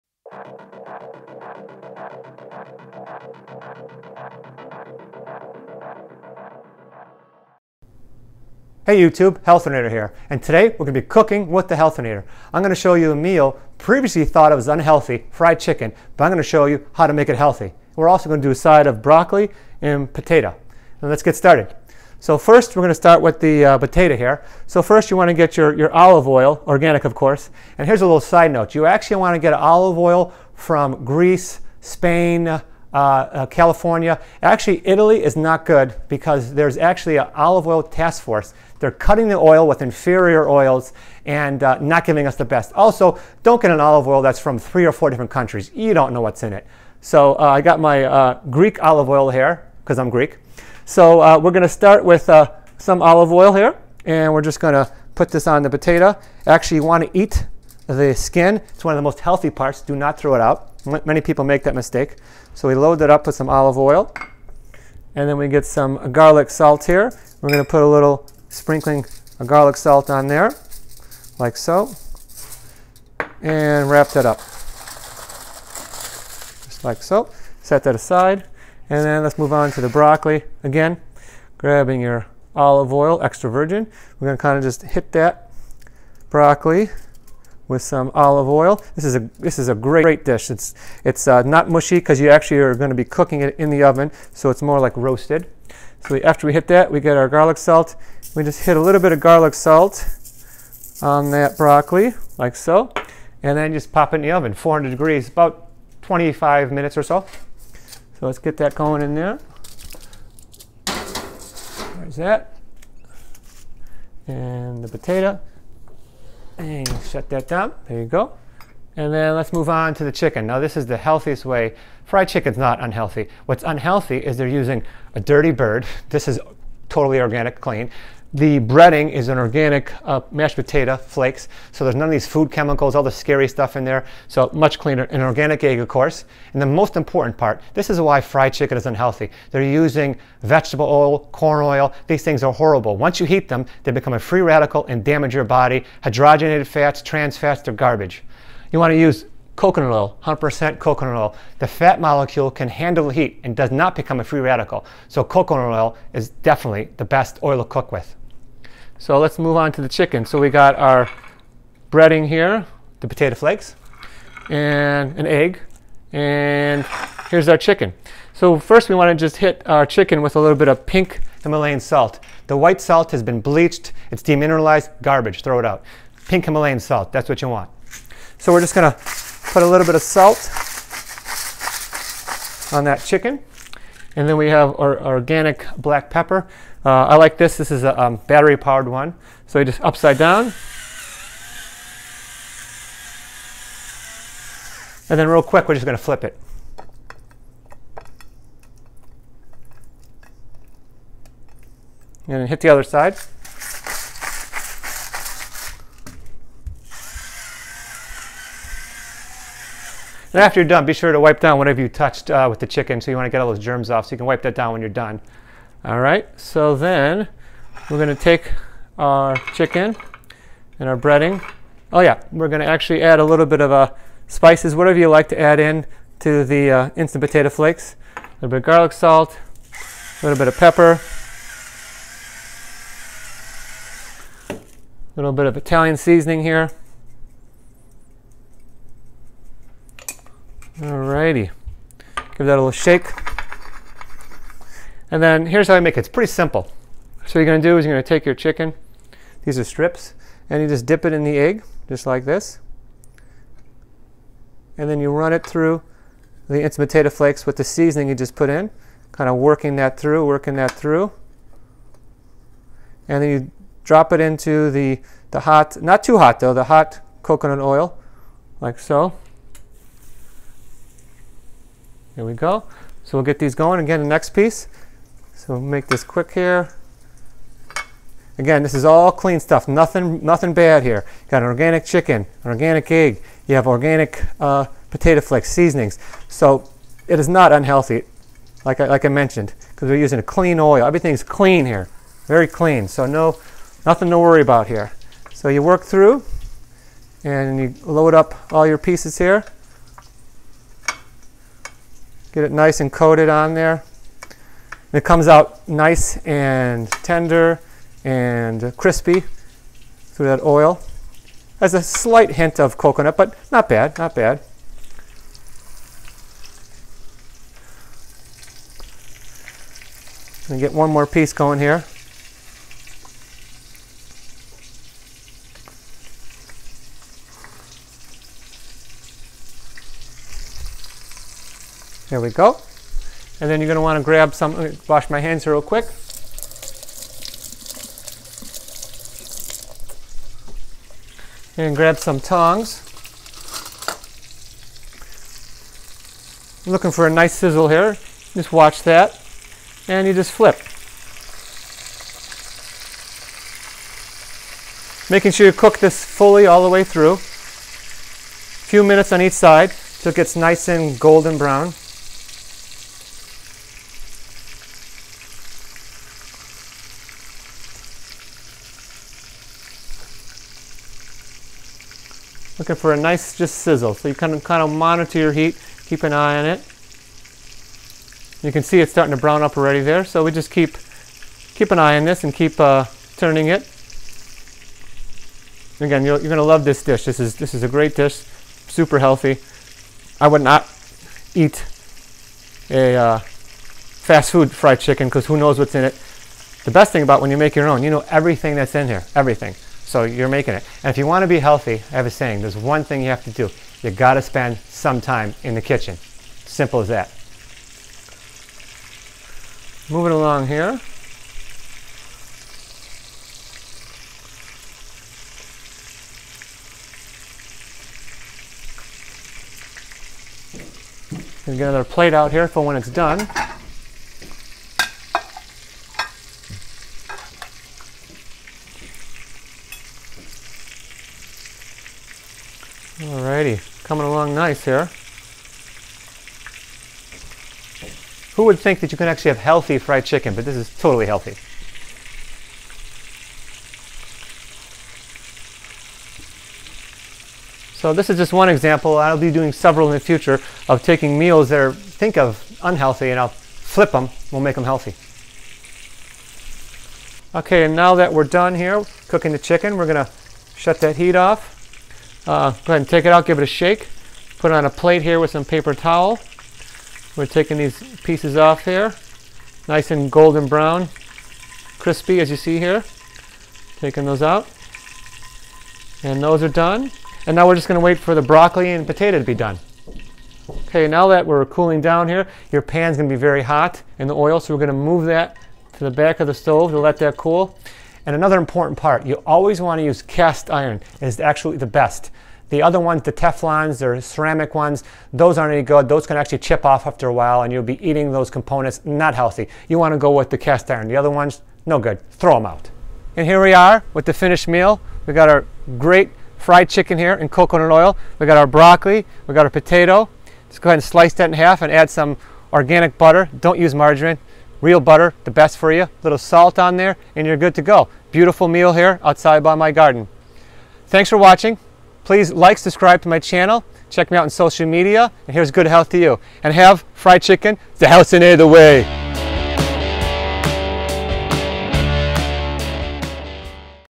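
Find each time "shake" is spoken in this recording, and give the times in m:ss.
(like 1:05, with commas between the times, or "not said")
4:02, 7:43.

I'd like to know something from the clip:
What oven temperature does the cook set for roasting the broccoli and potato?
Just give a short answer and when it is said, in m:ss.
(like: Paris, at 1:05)
400 degrees, at 1:44.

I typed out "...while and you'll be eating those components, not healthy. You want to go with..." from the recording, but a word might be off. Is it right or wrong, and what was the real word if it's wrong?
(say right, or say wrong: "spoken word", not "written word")
right.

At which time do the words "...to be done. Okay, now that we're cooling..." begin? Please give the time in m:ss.
7:59.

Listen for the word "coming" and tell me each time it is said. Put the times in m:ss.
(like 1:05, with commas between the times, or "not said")
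7:13.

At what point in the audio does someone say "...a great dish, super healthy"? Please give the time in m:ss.
6:27.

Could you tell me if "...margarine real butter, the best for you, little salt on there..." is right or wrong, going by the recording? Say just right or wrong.
right.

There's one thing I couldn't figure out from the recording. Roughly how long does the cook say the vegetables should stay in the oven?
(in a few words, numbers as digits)
25 minutes.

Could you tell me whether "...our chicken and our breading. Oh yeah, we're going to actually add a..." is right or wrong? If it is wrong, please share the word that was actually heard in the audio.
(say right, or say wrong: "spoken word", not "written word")
right.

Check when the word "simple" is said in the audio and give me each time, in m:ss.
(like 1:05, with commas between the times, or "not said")
4:06, 6:46.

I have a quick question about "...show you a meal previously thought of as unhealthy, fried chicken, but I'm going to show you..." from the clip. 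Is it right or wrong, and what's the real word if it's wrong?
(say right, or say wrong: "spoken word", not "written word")
right.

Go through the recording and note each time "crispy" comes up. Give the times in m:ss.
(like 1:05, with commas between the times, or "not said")
5:08, 7:51.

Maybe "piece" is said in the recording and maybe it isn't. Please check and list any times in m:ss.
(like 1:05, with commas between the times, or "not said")
4:34, 4:58, 5:21, 7:48.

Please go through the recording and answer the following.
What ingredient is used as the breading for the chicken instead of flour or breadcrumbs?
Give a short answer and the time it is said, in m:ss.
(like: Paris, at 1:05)
mashed potato flakes, at 2:10.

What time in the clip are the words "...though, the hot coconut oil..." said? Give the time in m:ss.
4:26.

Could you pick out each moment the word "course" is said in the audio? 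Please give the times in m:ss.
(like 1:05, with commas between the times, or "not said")
0:27, 2:15.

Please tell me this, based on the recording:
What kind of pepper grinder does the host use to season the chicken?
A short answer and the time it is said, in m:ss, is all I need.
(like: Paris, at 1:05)
battery powered, at 3:08.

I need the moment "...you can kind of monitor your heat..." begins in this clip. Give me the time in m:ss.
6:14.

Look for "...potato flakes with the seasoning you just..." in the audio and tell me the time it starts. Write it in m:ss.
4:16.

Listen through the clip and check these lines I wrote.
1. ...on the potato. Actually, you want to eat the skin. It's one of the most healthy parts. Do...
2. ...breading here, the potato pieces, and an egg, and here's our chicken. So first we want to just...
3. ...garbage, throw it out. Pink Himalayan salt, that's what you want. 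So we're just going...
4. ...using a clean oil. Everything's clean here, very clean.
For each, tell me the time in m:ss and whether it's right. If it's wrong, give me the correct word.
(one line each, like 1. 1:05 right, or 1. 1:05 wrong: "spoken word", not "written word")
1. 0:55 right
2. 2:41 wrong: "flakes", not "pieces"
3. 2:55 right
4. 4:49 right.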